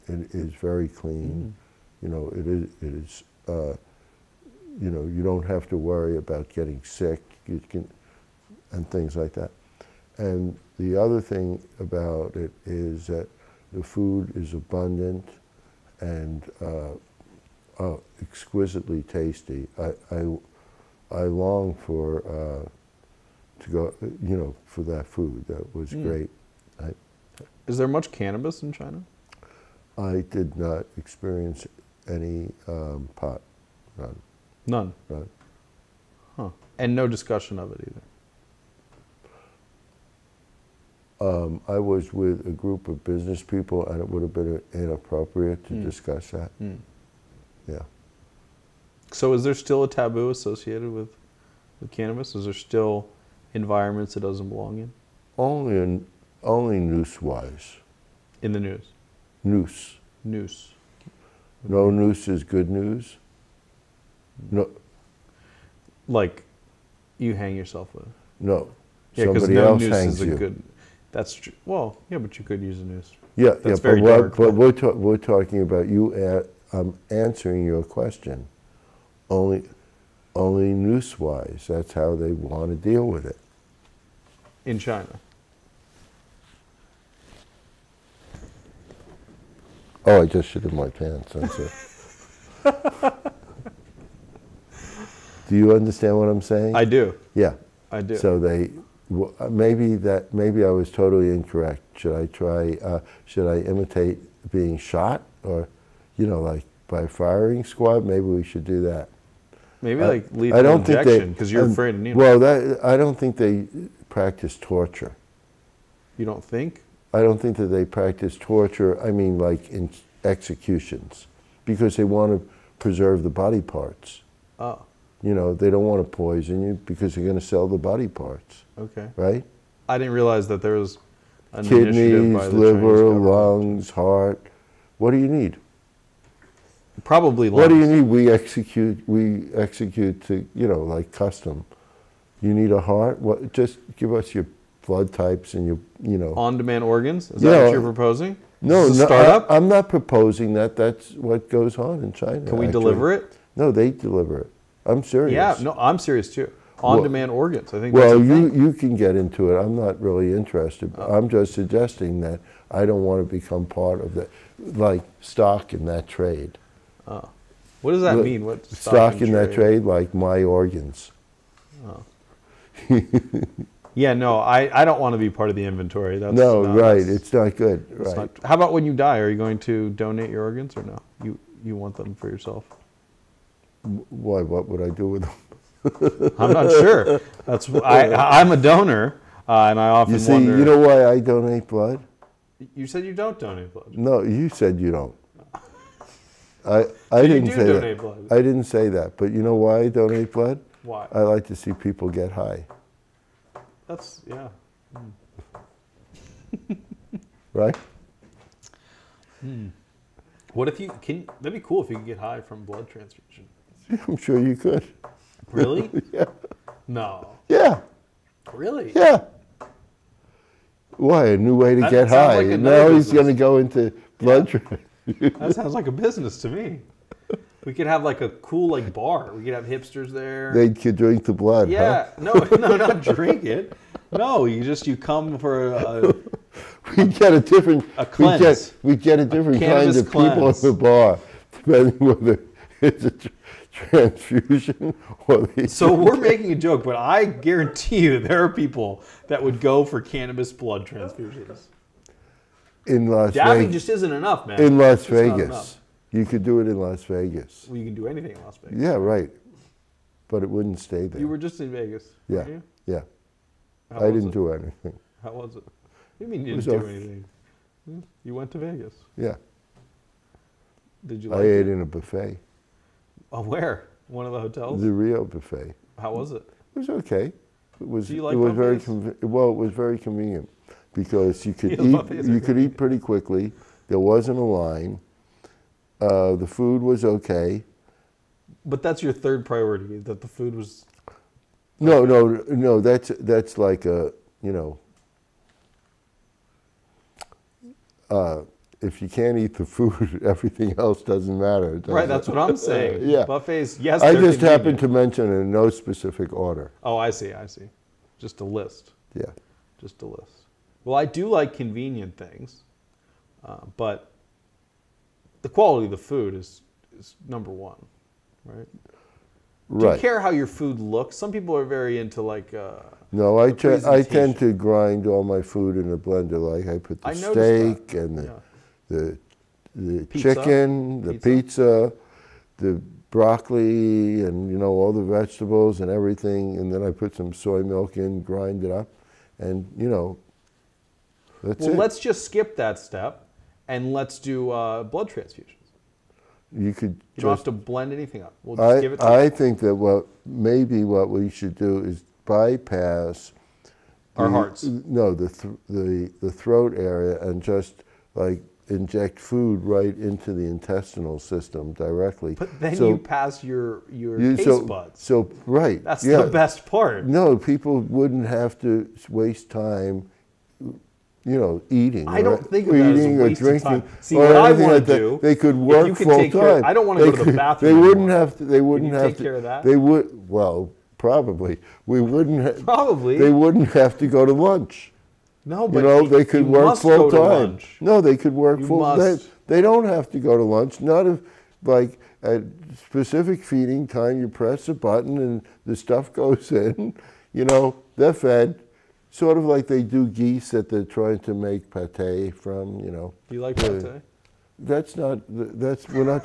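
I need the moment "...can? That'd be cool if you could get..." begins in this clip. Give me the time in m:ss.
3:31.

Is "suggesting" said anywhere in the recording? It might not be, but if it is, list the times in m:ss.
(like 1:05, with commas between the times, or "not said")
2:41.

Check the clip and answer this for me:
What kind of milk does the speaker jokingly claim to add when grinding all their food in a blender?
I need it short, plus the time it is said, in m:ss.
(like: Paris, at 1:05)
soy milk, at 5:37.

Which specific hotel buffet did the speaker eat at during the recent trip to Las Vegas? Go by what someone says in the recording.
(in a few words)
The Rio buffet.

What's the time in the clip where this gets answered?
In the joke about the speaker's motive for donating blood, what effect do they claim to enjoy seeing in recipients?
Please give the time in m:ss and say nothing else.
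3:21.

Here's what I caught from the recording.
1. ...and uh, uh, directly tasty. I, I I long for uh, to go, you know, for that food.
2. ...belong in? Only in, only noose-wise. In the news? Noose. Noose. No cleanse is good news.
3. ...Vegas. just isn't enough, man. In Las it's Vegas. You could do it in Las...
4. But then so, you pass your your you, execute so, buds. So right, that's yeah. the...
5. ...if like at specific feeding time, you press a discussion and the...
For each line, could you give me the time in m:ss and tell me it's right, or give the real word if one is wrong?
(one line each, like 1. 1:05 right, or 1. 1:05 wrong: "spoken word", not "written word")
1. 0:16 wrong: "exquisitely", not "directly"
2. 0:54 wrong: "noose", not "cleanse"
3. 4:13 right
4. 6:02 wrong: "taste", not "execute"
5. 6:31 wrong: "button", not "discussion".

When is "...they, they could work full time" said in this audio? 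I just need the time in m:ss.
6:26.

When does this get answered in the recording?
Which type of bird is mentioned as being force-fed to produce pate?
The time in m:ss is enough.
6:40.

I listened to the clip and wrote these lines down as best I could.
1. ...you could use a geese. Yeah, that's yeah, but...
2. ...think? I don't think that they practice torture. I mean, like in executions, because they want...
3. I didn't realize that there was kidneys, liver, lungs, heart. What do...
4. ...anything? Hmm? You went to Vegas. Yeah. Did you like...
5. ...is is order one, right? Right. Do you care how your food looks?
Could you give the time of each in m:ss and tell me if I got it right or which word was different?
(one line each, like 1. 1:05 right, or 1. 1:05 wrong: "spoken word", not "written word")
1. 1:12 wrong: "noose", not "geese"
2. 1:56 right
3. 2:09 right
4. 4:26 right
5. 5:16 wrong: "number", not "order".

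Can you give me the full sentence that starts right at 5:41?
let's just skip that step and let's do uh, blood transfusions.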